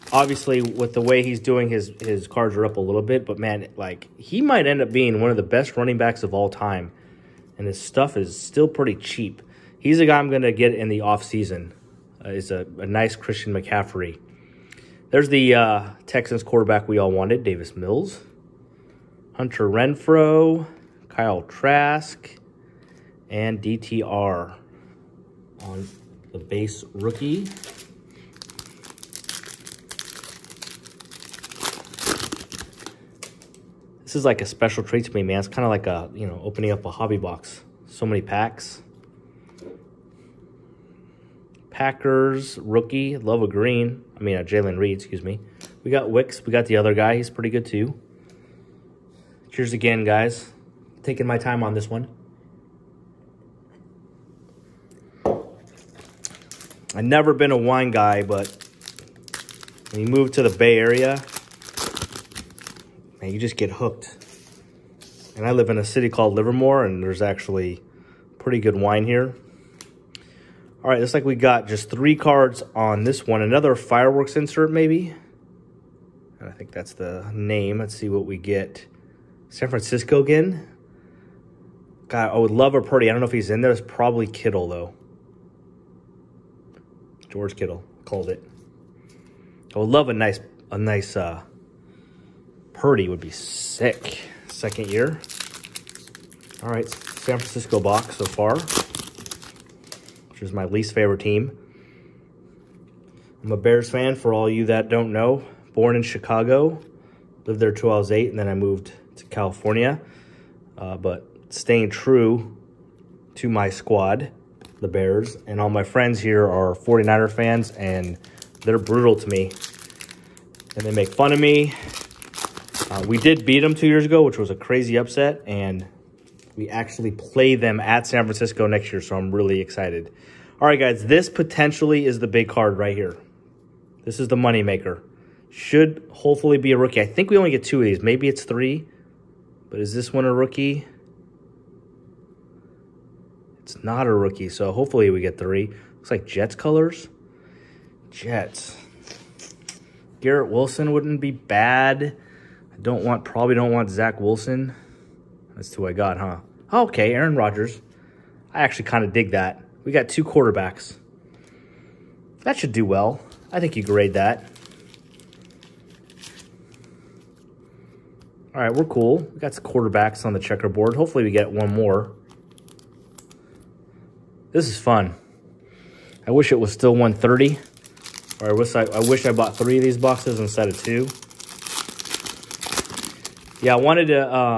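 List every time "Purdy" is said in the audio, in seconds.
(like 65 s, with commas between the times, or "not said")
82 s, 92 s.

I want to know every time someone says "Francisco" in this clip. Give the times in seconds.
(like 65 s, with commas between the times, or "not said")
79 s, 97 s, 128 s.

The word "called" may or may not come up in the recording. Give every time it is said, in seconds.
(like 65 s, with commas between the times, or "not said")
66 s, 88 s.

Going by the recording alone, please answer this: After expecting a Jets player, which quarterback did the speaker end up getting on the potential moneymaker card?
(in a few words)
Aaron Rodgers.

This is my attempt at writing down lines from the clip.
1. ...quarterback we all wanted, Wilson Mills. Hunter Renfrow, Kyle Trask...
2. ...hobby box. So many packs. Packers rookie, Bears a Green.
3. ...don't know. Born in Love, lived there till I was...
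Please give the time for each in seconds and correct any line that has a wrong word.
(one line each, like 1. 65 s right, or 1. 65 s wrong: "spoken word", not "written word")
1. 16 s wrong: "Davis", not "Wilson"
2. 36 s wrong: "Love", not "Bears"
3. 104 s wrong: "Chicago", not "Love".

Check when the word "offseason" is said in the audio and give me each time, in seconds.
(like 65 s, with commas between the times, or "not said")
10 s.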